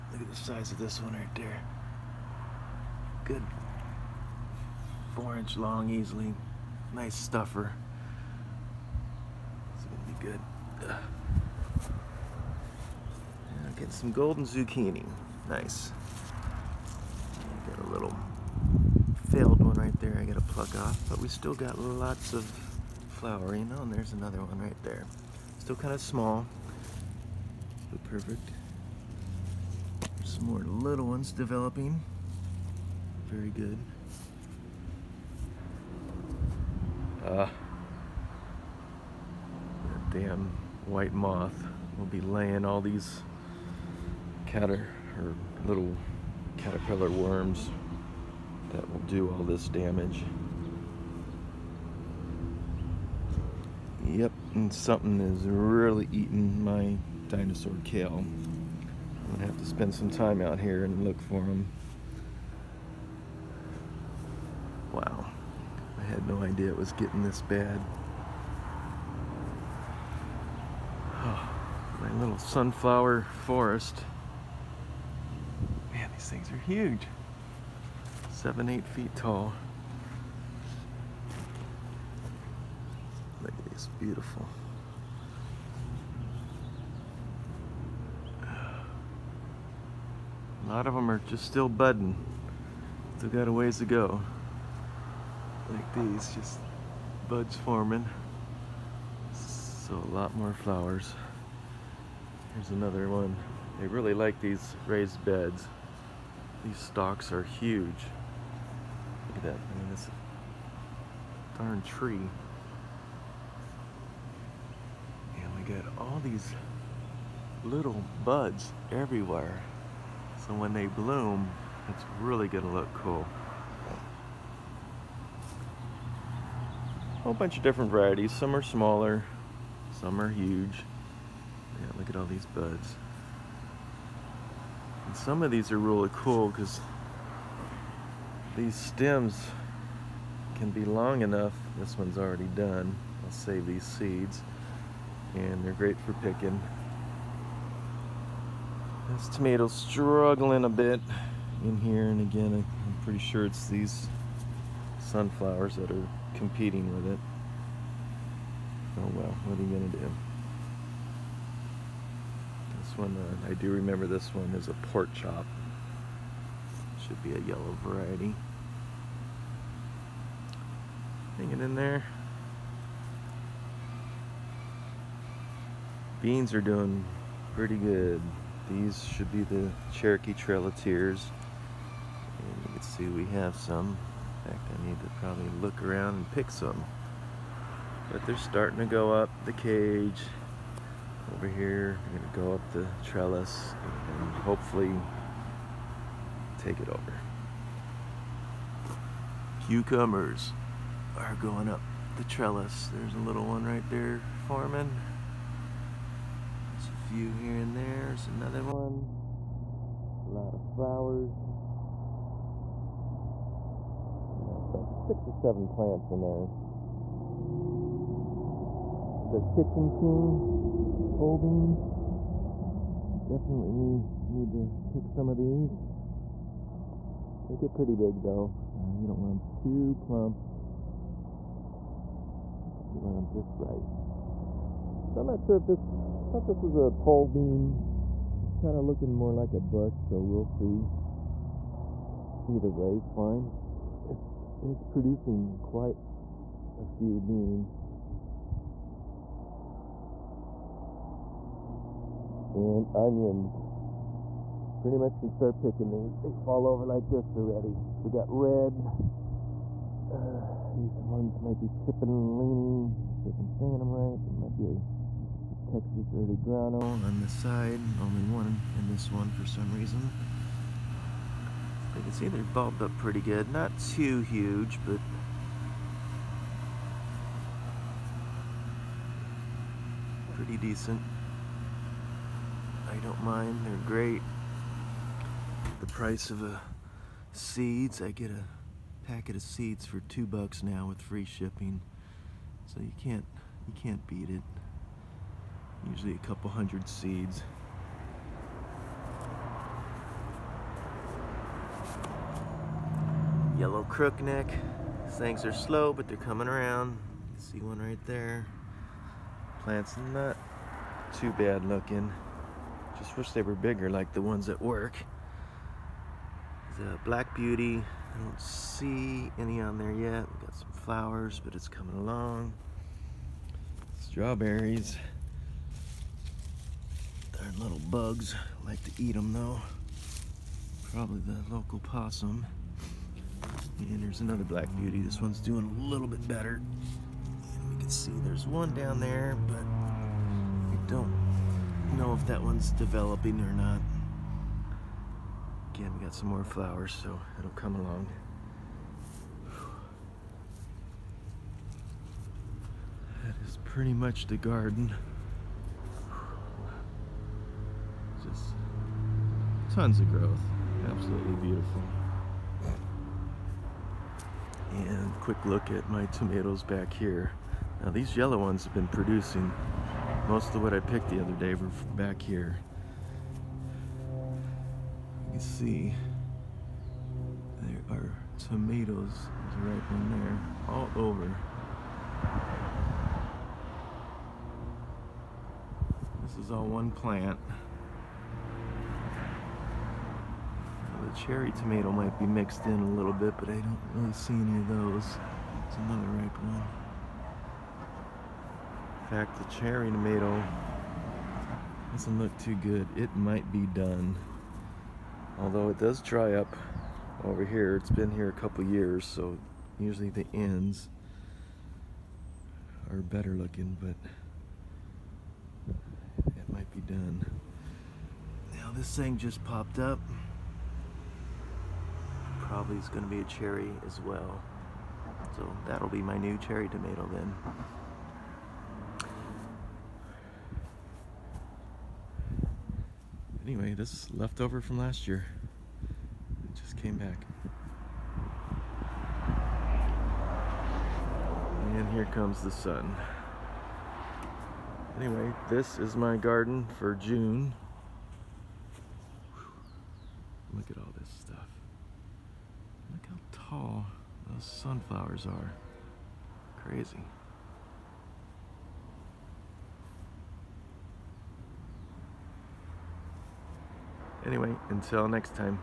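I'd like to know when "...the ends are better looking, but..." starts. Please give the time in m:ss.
6:50.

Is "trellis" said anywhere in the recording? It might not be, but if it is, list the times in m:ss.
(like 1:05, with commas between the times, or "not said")
3:13, 3:22.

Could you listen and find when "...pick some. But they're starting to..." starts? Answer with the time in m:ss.
3:06.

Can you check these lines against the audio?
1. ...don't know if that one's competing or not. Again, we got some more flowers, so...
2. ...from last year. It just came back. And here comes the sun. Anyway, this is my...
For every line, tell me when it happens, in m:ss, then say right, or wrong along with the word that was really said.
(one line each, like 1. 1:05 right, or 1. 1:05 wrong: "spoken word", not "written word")
1. 5:40 wrong: "developing", not "competing"
2. 7:14 right.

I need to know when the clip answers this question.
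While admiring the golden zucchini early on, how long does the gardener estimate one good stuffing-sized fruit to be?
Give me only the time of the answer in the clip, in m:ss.
0:05.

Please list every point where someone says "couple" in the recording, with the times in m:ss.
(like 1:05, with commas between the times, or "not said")
4:56, 6:48.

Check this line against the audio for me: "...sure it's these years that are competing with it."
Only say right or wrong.
wrong.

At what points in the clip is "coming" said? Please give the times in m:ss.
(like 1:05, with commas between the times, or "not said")
5:06, 5:21.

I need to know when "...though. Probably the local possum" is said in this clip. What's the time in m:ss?
5:29.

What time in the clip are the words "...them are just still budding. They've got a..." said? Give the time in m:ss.
1:30.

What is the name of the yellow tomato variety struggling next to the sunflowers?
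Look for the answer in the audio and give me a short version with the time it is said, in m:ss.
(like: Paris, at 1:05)
pork chop, at 2:44.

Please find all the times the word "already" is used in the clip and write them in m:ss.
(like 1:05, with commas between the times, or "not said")
2:22, 4:17.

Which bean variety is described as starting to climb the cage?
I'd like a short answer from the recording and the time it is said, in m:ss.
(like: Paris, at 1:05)
Cherokee Trail of Tears, at 2:59.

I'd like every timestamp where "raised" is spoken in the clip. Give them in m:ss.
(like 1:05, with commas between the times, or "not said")
1:44.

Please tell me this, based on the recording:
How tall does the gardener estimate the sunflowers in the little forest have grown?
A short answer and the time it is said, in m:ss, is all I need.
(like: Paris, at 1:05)
7 to 8 feet, at 1:18.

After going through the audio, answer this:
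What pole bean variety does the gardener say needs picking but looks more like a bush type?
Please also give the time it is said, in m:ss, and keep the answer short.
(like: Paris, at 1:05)
Kitchen King, at 3:39.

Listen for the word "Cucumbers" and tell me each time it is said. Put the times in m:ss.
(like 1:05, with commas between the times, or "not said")
3:19.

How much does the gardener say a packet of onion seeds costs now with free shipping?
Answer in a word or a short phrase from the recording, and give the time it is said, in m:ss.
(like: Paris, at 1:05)
$2, at 4:50.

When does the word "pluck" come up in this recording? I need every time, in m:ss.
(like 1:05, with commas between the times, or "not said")
0:20.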